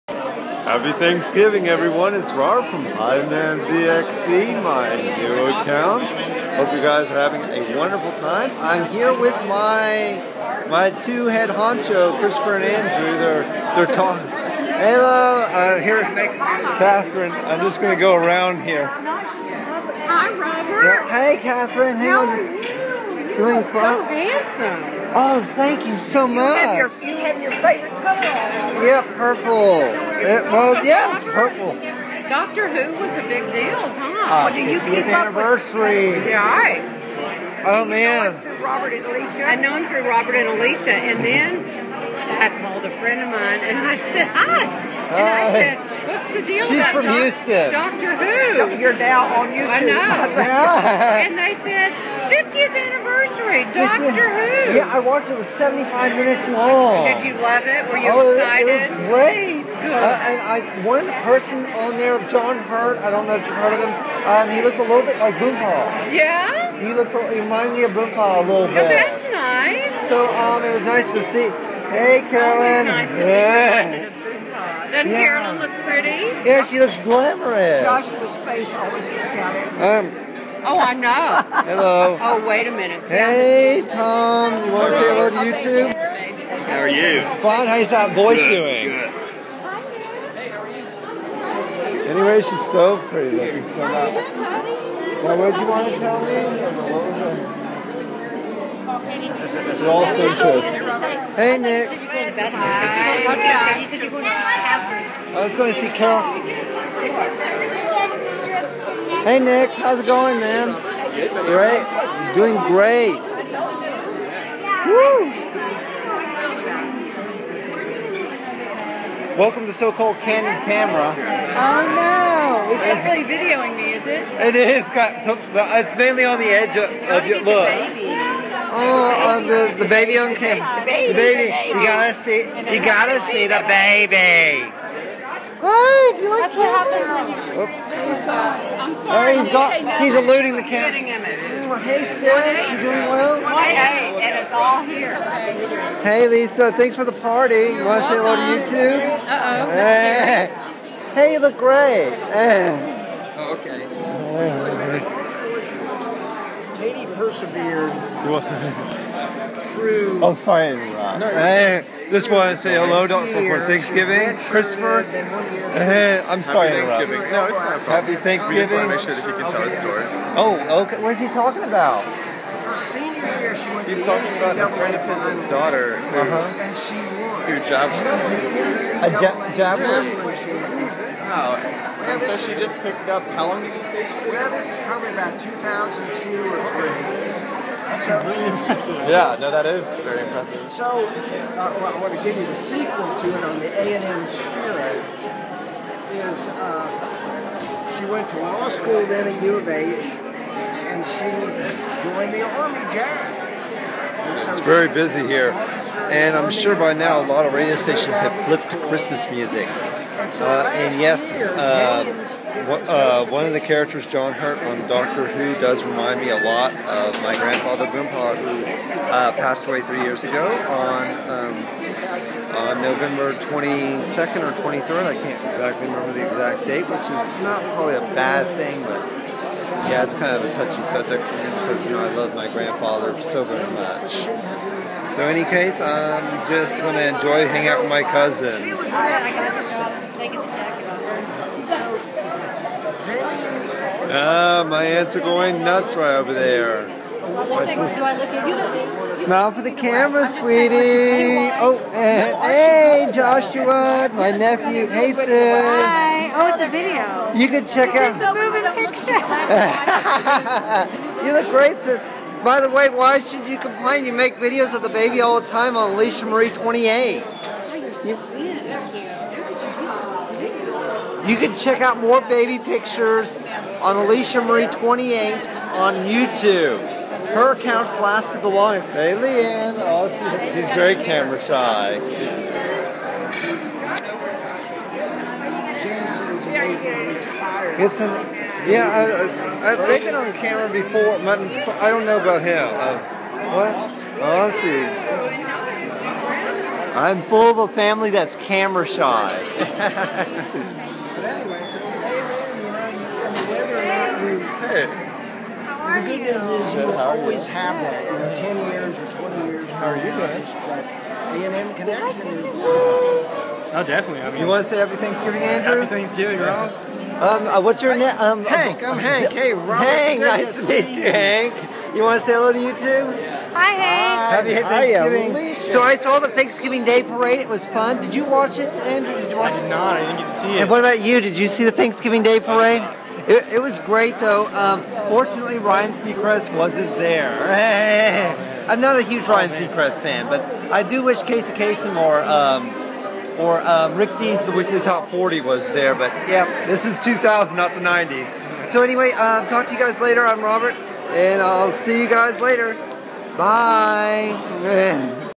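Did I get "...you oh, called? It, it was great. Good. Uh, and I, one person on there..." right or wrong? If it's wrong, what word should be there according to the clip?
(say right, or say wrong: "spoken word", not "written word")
wrong: "excited", not "called".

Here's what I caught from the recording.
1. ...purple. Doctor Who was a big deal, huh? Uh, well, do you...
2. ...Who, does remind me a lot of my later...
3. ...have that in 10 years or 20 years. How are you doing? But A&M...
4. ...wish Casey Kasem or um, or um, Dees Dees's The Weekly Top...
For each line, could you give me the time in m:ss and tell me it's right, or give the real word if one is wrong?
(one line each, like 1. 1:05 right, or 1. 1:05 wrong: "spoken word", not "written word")
1. 0:31 right
2. 3:35 wrong: "grandfather", not "later"
3. 5:07 right
4. 5:41 wrong: "Rick", not "Dees".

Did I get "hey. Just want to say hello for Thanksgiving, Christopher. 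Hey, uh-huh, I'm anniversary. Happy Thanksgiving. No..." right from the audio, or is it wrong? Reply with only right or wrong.
wrong.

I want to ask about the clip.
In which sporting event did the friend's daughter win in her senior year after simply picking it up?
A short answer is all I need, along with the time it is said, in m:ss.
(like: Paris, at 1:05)
Javelin, at 2:59.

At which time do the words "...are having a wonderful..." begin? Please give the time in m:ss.
0:07.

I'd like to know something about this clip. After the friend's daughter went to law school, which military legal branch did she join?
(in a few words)
Army JAG.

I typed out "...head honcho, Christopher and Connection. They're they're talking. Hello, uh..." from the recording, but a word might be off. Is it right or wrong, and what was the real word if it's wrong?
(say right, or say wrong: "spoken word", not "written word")
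wrong: "Andrew", not "Connection".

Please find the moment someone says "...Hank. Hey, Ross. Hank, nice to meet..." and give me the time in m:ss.
5:18.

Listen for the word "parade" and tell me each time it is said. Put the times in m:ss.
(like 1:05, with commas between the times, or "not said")
5:27, 5:32.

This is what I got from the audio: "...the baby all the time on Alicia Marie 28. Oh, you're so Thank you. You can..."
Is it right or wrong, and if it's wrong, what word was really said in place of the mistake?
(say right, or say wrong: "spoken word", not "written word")
right.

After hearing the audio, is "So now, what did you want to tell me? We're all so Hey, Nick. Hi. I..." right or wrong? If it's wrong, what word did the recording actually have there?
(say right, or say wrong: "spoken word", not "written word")
right.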